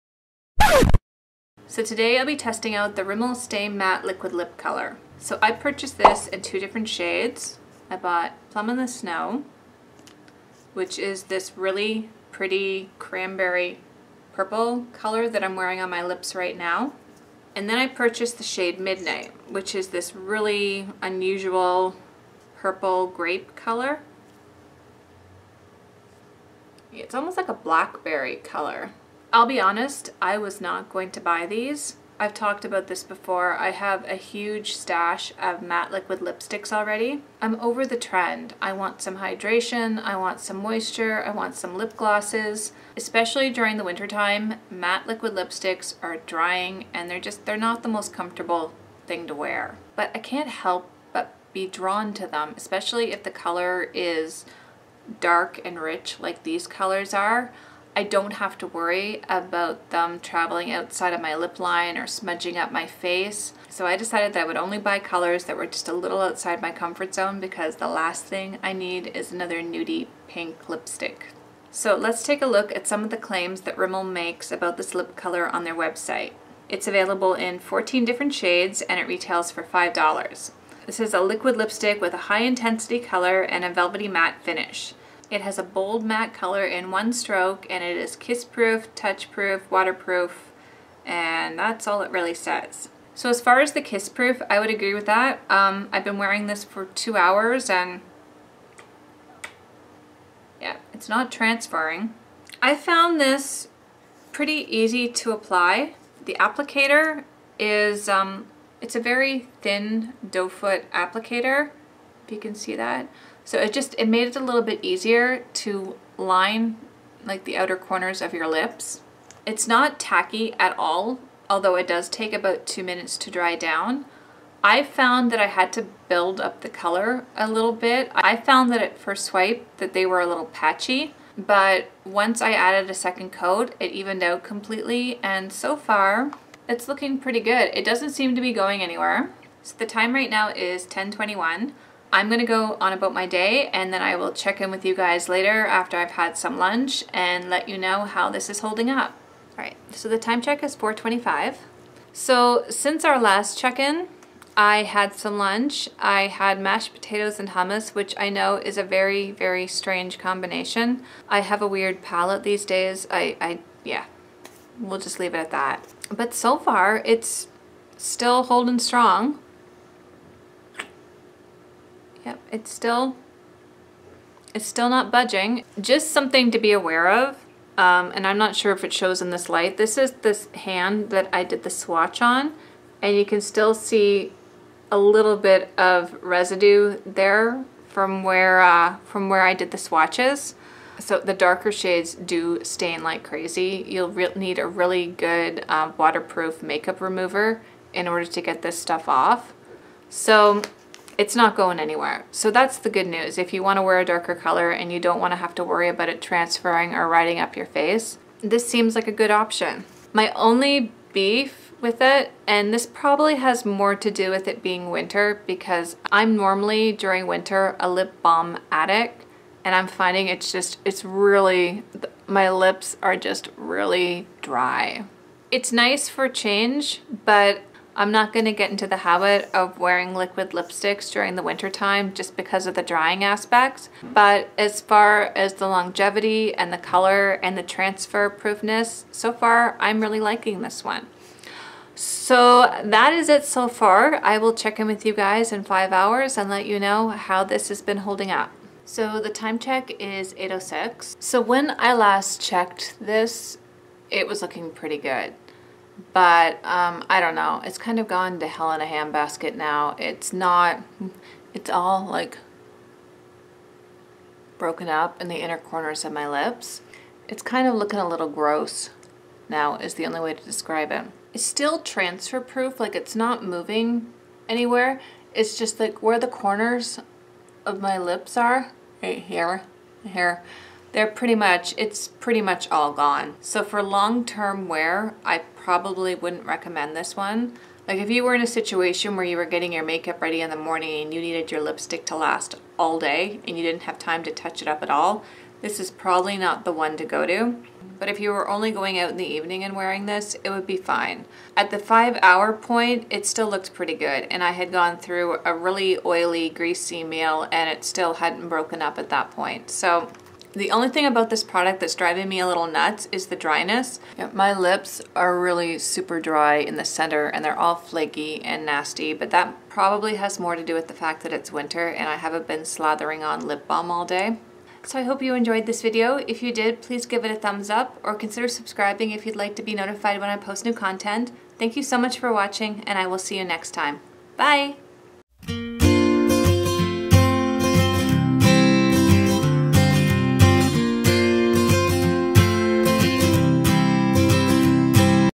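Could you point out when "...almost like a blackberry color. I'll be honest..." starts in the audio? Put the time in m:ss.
0:27.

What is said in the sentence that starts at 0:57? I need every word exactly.
I don't have to worry about them traveling outside of my lip line or smudging up my face.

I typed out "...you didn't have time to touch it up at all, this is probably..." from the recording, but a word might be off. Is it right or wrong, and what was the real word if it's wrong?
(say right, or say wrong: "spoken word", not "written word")
right.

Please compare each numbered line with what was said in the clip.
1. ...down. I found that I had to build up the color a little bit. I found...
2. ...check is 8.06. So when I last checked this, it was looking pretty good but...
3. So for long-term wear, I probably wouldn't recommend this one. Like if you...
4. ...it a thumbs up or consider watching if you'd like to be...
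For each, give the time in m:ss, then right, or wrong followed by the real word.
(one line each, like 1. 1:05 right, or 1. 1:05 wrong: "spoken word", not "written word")
1. 2:03 right
2. 4:09 right
3. 4:43 right
4. 5:27 wrong: "subscribing", not "watching".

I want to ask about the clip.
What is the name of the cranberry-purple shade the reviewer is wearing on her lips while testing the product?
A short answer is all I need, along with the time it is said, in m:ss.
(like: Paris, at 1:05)
Plum This Show, at 0:08.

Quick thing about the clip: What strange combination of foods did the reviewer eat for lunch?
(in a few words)
mashed potatoes and hummus.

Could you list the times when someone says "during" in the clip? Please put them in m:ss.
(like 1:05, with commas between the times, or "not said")
0:43, 3:36, 3:51.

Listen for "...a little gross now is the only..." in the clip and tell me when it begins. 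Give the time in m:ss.
4:27.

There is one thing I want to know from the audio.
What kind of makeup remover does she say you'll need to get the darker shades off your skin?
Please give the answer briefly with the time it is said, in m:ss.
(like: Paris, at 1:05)
waterproof makeup remover, at 3:15.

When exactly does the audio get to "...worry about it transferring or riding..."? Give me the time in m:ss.
3:25.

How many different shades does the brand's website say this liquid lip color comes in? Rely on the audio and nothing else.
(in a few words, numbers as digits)
14.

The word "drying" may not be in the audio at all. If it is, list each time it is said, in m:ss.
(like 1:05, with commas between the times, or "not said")
0:46, 3:52.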